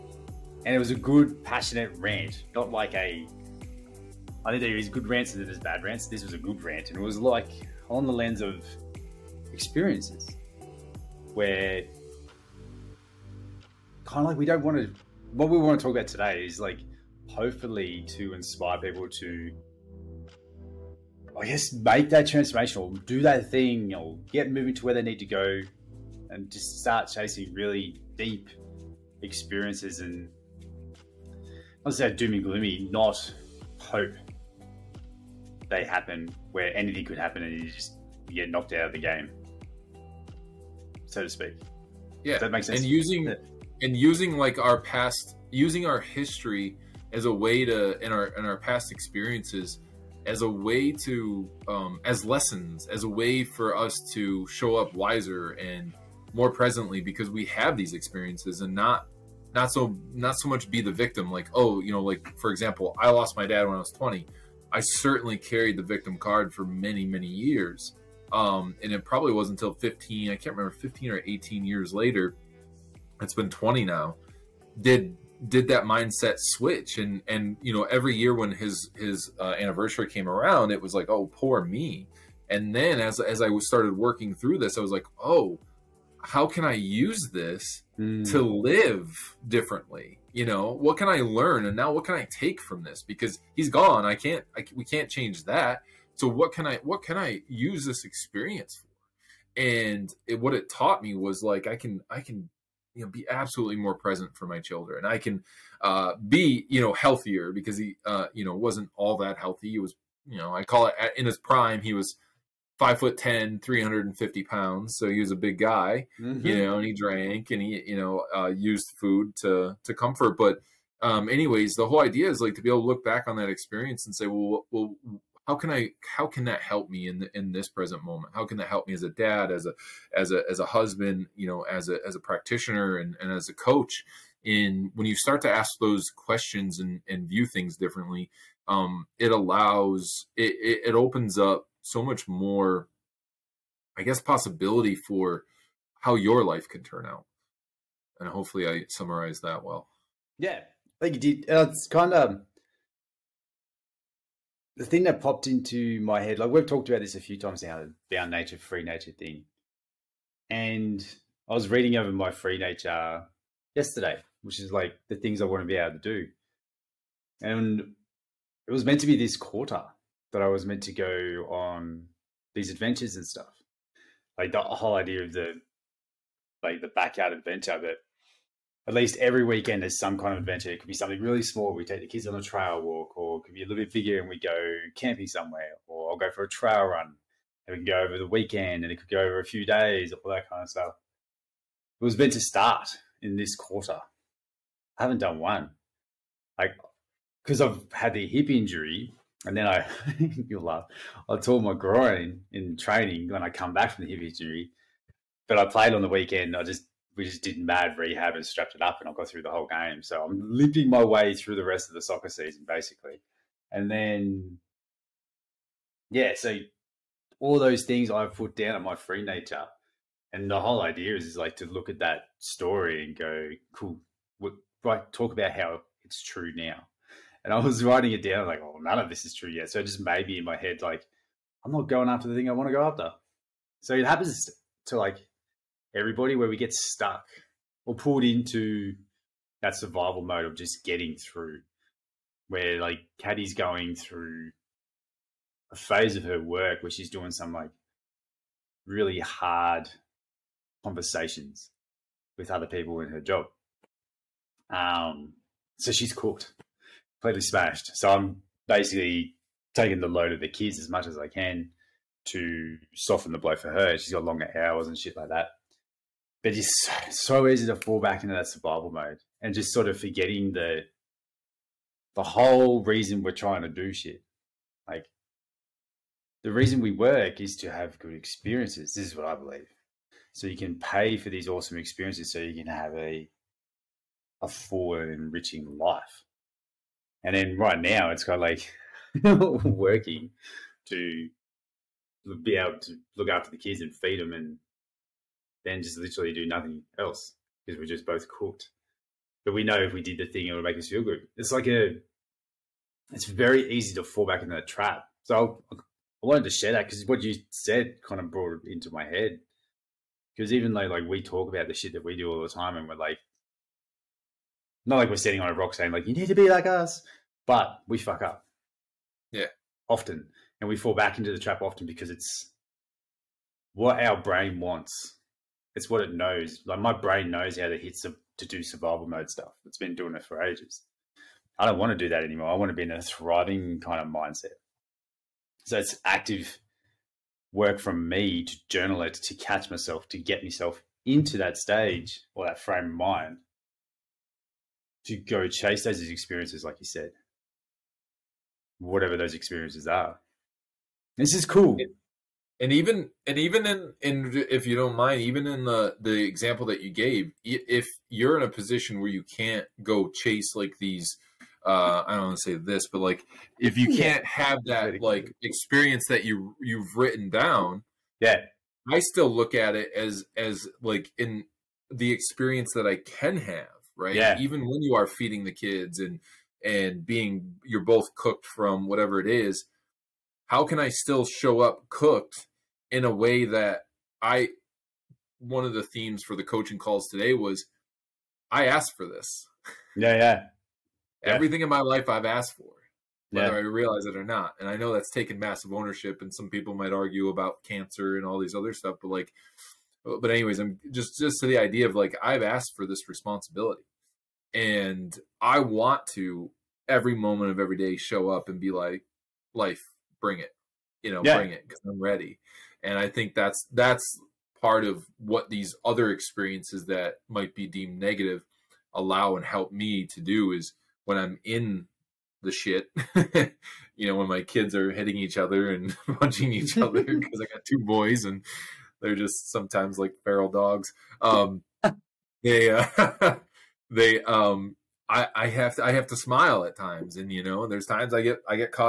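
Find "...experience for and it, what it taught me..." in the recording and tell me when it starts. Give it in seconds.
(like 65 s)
98 s.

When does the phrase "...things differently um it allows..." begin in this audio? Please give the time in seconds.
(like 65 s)
137 s.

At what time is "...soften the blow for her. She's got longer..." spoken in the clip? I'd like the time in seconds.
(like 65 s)
262 s.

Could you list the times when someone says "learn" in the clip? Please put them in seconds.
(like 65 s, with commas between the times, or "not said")
91 s.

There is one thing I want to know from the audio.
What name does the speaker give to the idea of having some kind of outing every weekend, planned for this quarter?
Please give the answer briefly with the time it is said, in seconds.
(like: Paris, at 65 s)
backyard adventure, at 176 s.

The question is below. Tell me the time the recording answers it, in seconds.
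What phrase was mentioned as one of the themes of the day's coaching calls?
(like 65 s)
388 s.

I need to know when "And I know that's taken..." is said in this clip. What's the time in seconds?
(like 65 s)
394 s.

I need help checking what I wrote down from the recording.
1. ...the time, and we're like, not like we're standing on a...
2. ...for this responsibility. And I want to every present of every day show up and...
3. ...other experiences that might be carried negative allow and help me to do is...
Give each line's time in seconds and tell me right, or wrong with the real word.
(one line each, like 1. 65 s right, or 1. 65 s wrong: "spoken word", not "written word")
1. 312 s right
2. 402 s wrong: "moment", not "present"
3. 415 s wrong: "deemed", not "carried".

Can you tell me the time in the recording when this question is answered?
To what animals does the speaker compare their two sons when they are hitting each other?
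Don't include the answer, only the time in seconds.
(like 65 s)
430 s.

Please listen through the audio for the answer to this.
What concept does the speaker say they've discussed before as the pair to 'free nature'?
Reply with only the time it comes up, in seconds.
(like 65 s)
158 s.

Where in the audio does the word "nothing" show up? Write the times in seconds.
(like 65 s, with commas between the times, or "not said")
296 s.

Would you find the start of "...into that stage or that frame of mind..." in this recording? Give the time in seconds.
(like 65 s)
341 s.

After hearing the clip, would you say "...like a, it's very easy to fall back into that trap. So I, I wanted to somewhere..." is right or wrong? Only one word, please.
wrong.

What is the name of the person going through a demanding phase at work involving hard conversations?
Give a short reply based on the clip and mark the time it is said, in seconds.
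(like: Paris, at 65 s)
Caddy, at 243 s.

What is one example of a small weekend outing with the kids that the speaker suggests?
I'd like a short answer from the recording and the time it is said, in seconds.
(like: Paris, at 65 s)
trail walk, at 182 s.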